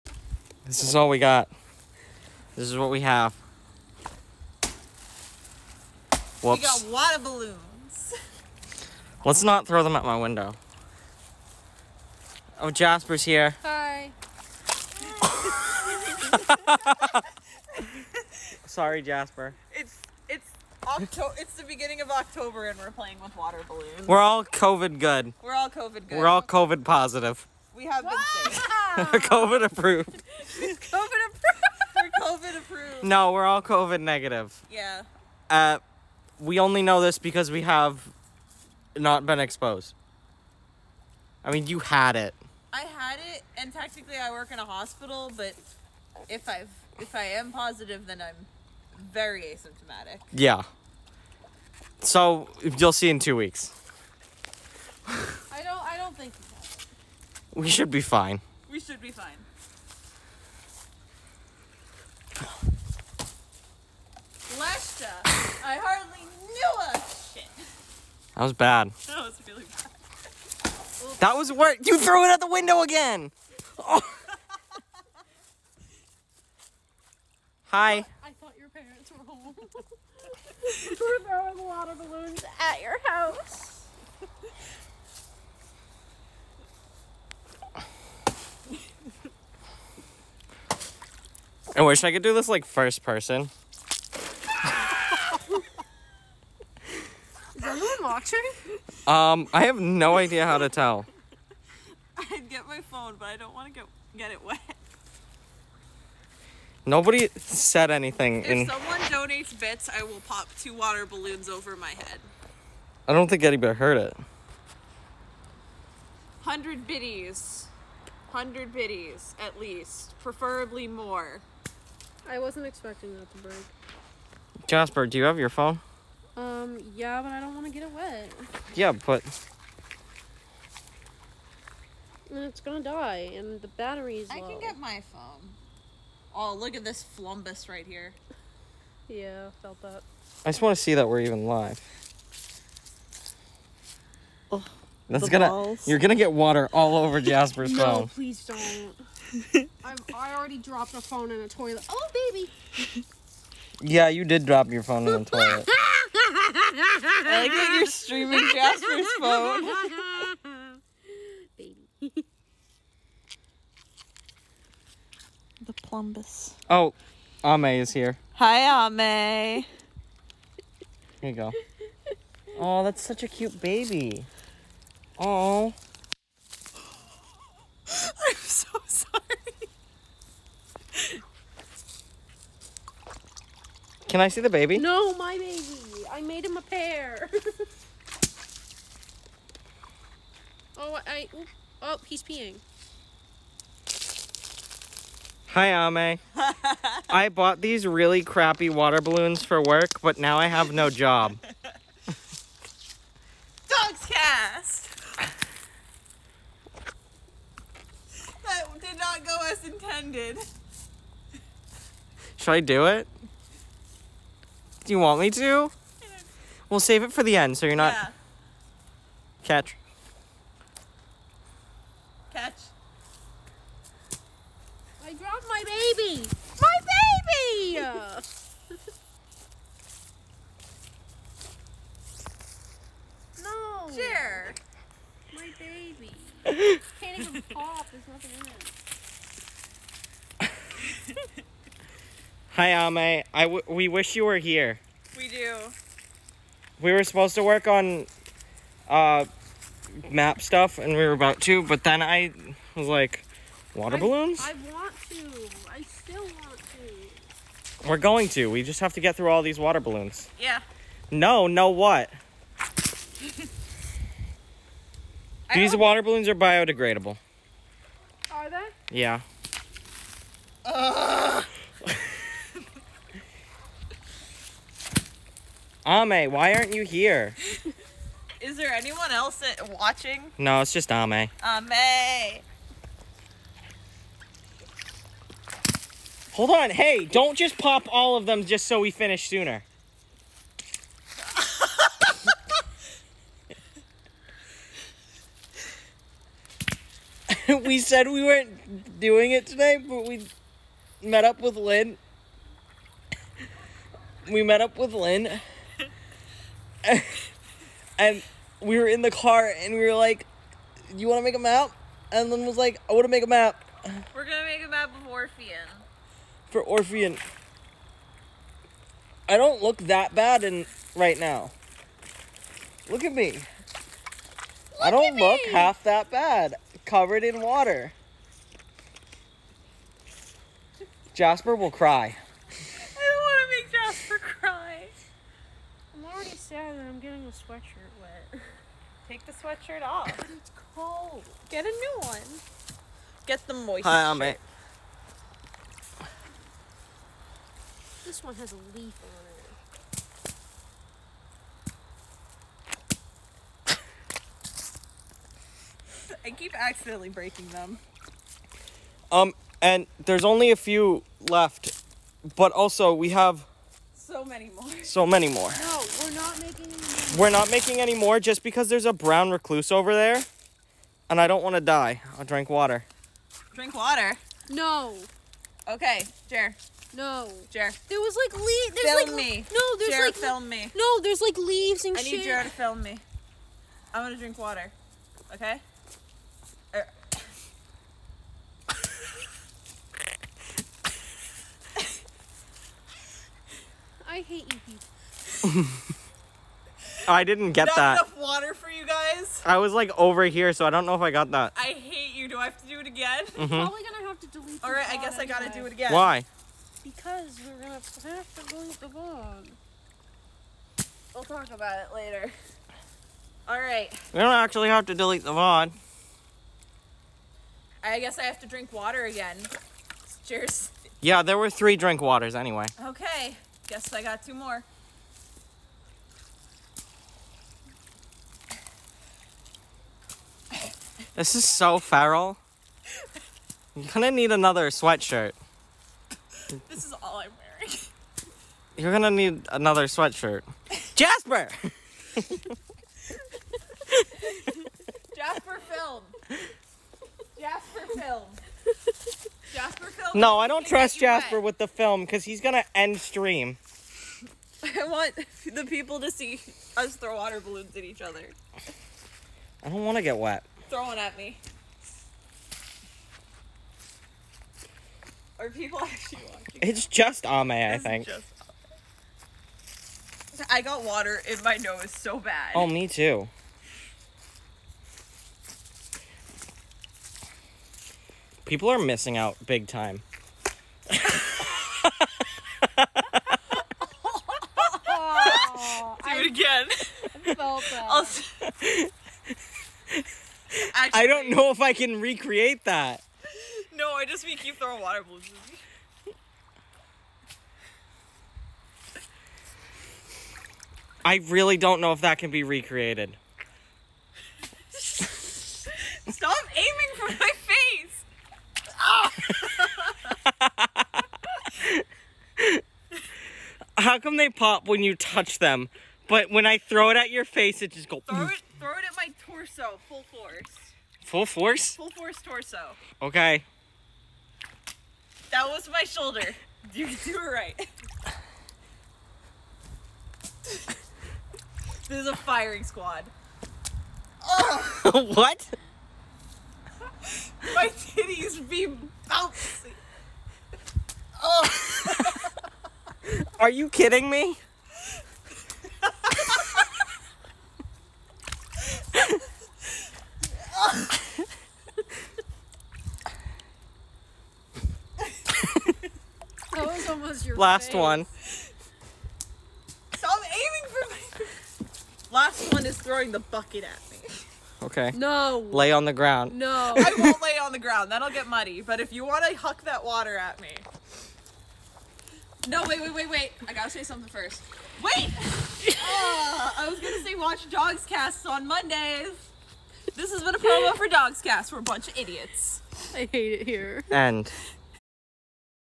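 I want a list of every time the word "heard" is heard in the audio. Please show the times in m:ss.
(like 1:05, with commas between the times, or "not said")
1:53.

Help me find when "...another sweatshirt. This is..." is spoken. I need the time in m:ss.
7:14.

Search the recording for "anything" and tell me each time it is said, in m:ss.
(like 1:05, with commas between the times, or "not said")
1:47.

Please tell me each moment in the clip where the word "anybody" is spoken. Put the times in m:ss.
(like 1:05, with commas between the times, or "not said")
1:53.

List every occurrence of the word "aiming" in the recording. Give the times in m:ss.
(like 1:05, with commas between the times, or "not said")
8:26, 9:20.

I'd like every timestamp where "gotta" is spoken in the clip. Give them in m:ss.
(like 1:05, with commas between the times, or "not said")
6:45, 9:33.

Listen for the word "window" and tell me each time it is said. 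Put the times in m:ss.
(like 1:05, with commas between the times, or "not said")
0:10, 1:12.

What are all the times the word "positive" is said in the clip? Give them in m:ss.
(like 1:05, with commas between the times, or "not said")
0:26, 0:47.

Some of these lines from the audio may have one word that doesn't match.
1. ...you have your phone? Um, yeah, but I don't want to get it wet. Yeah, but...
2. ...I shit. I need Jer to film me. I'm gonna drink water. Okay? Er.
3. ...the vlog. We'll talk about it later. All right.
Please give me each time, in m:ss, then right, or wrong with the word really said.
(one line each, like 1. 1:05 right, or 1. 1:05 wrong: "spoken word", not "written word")
1. 2:05 right
2. 6:21 right
3. 6:48 right.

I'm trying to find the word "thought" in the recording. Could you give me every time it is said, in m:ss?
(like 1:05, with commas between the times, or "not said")
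1:18.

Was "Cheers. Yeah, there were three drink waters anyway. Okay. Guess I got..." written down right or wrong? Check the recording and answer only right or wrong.
right.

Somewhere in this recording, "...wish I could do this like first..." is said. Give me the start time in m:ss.
1:31.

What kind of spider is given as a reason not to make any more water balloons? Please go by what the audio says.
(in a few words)
brown recluse.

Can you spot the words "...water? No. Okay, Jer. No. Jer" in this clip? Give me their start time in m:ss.
6:13.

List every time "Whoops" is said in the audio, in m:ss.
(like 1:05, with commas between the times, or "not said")
0:06.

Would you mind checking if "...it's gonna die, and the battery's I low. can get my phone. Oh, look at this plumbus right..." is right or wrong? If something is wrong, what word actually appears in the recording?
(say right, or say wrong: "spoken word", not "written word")
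right.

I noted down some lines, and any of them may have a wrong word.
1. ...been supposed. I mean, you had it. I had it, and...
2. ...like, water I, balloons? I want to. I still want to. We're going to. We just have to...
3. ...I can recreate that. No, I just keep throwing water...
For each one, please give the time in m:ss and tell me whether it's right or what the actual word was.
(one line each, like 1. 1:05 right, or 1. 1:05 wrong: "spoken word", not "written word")
1. 0:39 wrong: "exposed", not "supposed"
2. 4:12 right
3. 8:11 right.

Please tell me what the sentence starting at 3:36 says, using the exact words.
We'll save it for the end so you're not.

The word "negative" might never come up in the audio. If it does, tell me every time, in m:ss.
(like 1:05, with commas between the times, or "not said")
0:34.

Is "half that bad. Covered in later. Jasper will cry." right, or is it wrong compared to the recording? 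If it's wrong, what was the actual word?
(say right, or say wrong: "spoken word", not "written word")
wrong: "water", not "later".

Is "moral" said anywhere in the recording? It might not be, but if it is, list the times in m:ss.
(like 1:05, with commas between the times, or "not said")
not said.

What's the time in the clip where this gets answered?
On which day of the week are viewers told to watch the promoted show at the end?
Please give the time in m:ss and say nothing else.
9:37.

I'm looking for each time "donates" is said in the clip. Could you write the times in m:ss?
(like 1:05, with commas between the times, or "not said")
1:49.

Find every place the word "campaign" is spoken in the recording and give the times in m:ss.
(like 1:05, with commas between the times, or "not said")
not said.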